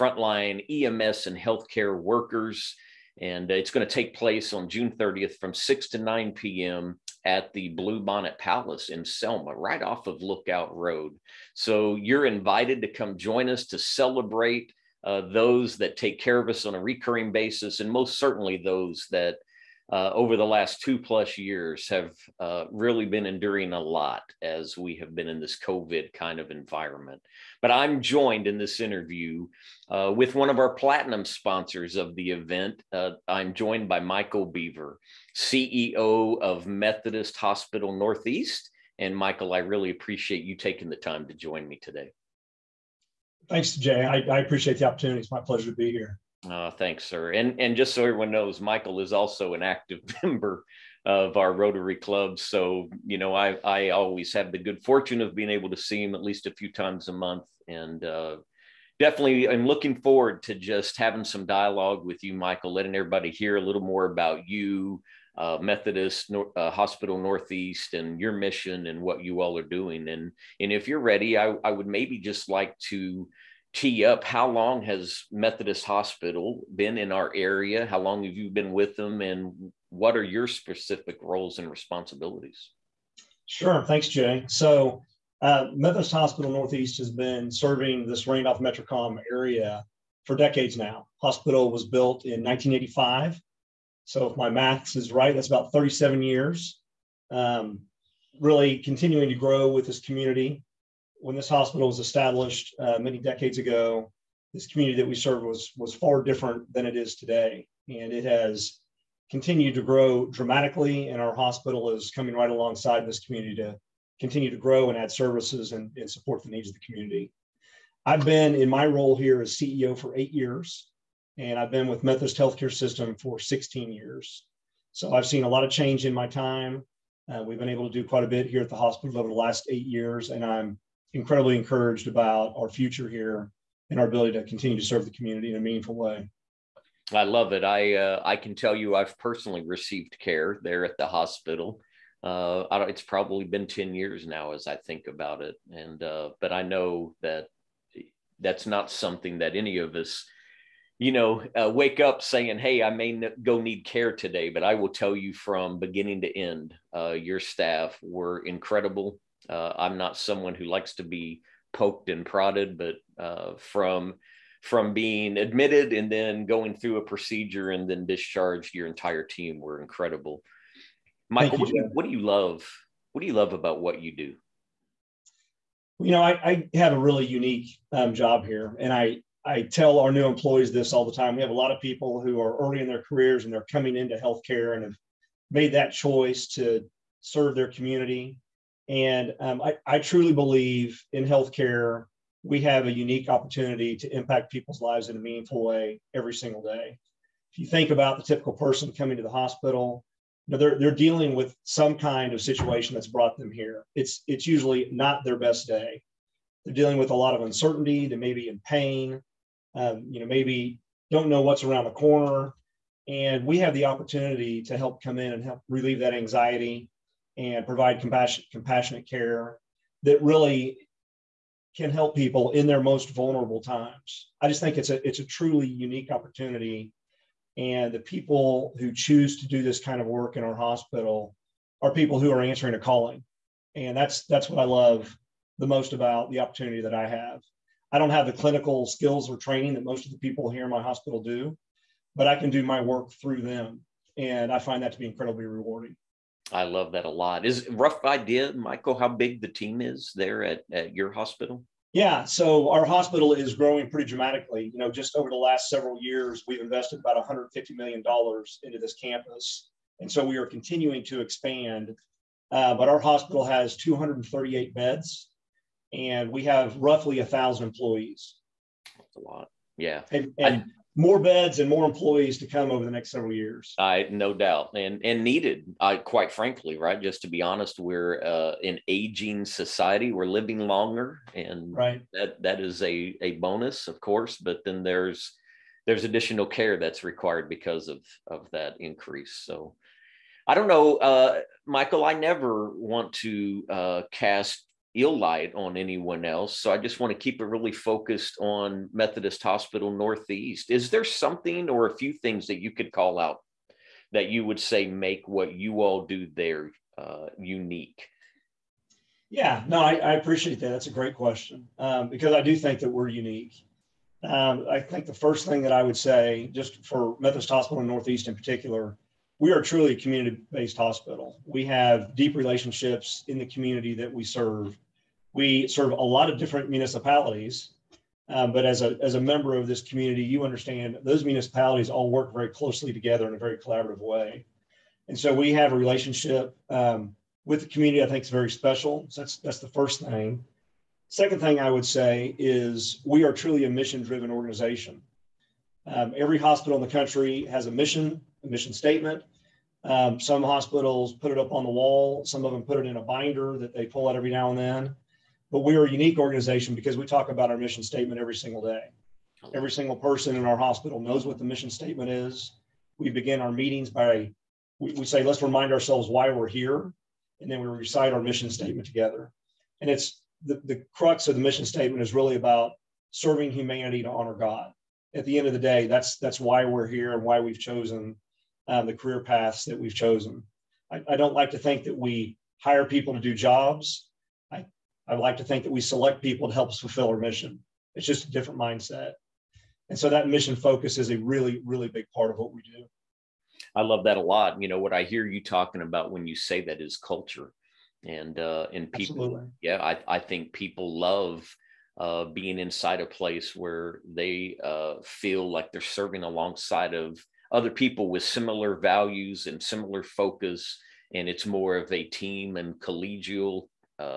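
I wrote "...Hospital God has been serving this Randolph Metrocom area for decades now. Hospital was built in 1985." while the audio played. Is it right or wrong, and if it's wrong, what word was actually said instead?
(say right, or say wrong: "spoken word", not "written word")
wrong: "Northeast", not "God".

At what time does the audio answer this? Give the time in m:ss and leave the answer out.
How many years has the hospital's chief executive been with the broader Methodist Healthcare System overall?
2:03.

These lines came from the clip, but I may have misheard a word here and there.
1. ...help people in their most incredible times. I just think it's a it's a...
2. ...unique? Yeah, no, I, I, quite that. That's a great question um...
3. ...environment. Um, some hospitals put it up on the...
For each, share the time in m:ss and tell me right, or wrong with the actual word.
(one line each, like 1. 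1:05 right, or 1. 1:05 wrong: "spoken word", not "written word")
1. 3:41 wrong: "vulnerable", not "incredible"
2. 5:07 wrong: "appreciate", not "quite"
3. 5:48 wrong: "statement", not "environment".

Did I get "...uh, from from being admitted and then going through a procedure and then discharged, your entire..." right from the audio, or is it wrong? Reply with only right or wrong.
right.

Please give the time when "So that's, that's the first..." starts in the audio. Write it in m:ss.
5:39.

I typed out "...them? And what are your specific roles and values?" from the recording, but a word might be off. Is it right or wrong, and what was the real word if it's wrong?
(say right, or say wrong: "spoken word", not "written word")
wrong: "responsibilities", not "values".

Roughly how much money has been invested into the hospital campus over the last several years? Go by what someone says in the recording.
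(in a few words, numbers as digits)
150 million dollars.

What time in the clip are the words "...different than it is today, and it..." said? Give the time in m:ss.
1:46.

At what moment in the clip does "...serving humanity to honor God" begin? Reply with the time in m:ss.
6:13.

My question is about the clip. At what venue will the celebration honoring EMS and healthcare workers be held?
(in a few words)
Bluebonnet Palace.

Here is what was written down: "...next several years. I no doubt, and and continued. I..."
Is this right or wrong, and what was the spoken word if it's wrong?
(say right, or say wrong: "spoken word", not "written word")
wrong: "needed", not "continued".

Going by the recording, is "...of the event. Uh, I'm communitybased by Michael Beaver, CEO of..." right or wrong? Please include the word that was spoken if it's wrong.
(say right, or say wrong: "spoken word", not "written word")
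wrong: "joined", not "communitybased".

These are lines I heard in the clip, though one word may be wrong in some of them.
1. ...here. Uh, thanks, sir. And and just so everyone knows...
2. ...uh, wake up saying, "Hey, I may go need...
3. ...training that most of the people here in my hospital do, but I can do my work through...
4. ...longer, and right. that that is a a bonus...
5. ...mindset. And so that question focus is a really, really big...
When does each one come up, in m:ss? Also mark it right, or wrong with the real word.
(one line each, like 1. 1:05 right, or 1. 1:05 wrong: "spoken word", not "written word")
1. 0:45 right
2. 2:31 right
3. 3:59 right
4. 4:40 right
5. 6:28 wrong: "mission", not "question".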